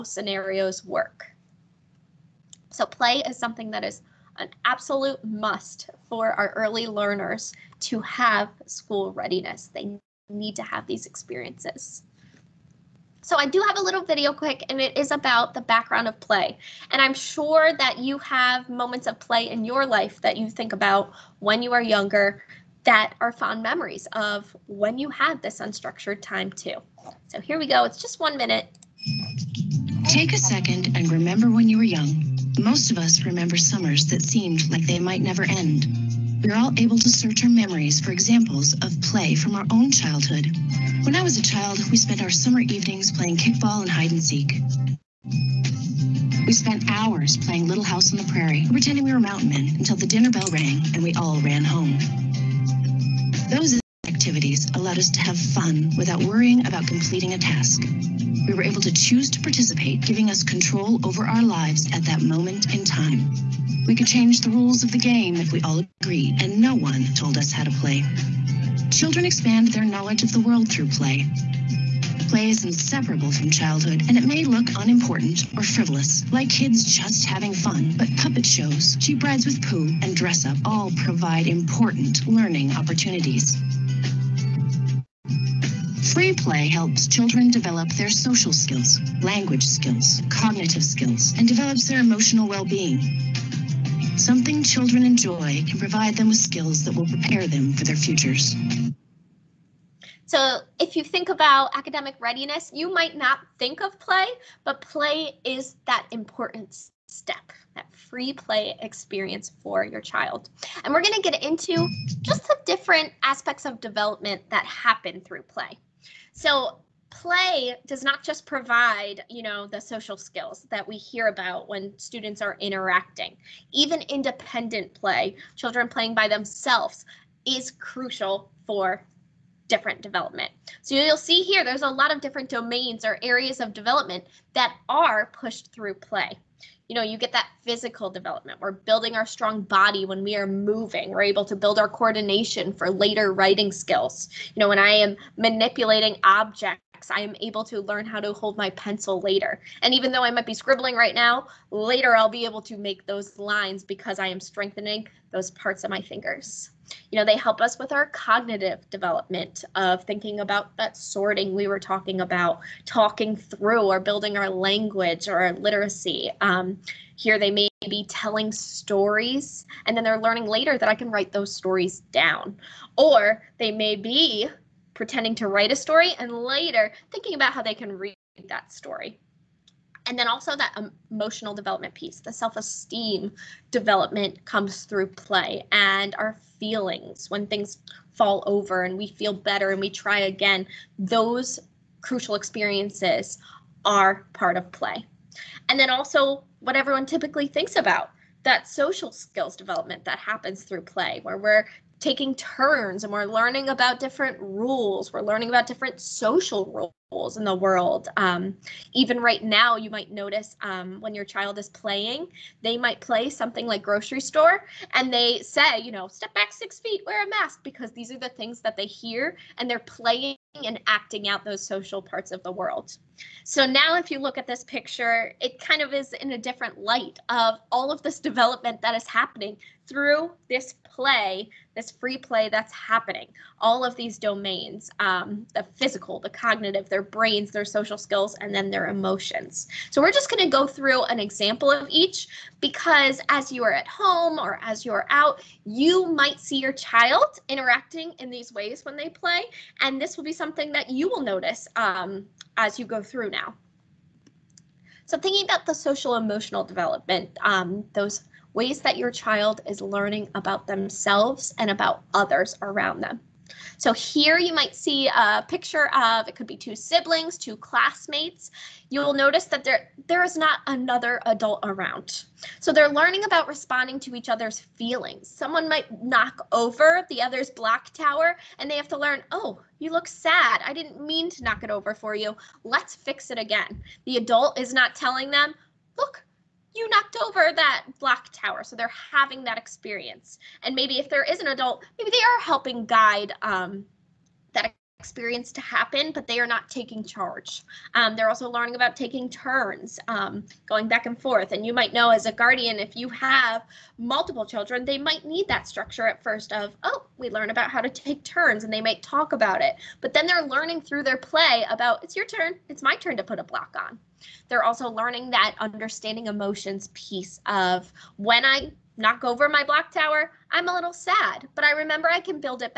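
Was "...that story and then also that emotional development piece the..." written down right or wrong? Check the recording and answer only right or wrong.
right.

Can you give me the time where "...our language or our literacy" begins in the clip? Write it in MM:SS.
02:44.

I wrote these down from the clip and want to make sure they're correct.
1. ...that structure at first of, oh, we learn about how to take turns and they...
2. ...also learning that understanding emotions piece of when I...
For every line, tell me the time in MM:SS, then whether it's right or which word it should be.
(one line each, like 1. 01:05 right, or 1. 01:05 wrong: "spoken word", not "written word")
1. 05:05 right
2. 05:14 right.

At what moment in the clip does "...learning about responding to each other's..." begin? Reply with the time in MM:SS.
04:32.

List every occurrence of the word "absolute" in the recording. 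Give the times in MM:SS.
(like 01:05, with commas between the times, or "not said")
00:04.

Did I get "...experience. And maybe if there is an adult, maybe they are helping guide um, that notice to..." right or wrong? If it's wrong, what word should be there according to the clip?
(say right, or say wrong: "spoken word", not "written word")
wrong: "experience", not "notice".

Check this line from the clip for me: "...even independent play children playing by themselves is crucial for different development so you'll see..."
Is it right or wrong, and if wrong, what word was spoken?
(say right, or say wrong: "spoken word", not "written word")
right.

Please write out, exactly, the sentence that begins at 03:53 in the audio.
All of these domains um, the physical, the cognitive, the their brains, their social skills, and then their emotions.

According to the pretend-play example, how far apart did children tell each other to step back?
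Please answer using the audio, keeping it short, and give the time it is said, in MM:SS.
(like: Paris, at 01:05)
6 feet, at 03:36.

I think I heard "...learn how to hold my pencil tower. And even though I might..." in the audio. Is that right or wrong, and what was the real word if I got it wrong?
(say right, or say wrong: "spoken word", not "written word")
wrong: "later", not "tower".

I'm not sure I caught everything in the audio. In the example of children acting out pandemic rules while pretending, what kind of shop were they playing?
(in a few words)
grocery store.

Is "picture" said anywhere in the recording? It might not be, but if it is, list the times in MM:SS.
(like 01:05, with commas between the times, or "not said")
03:44, 04:25.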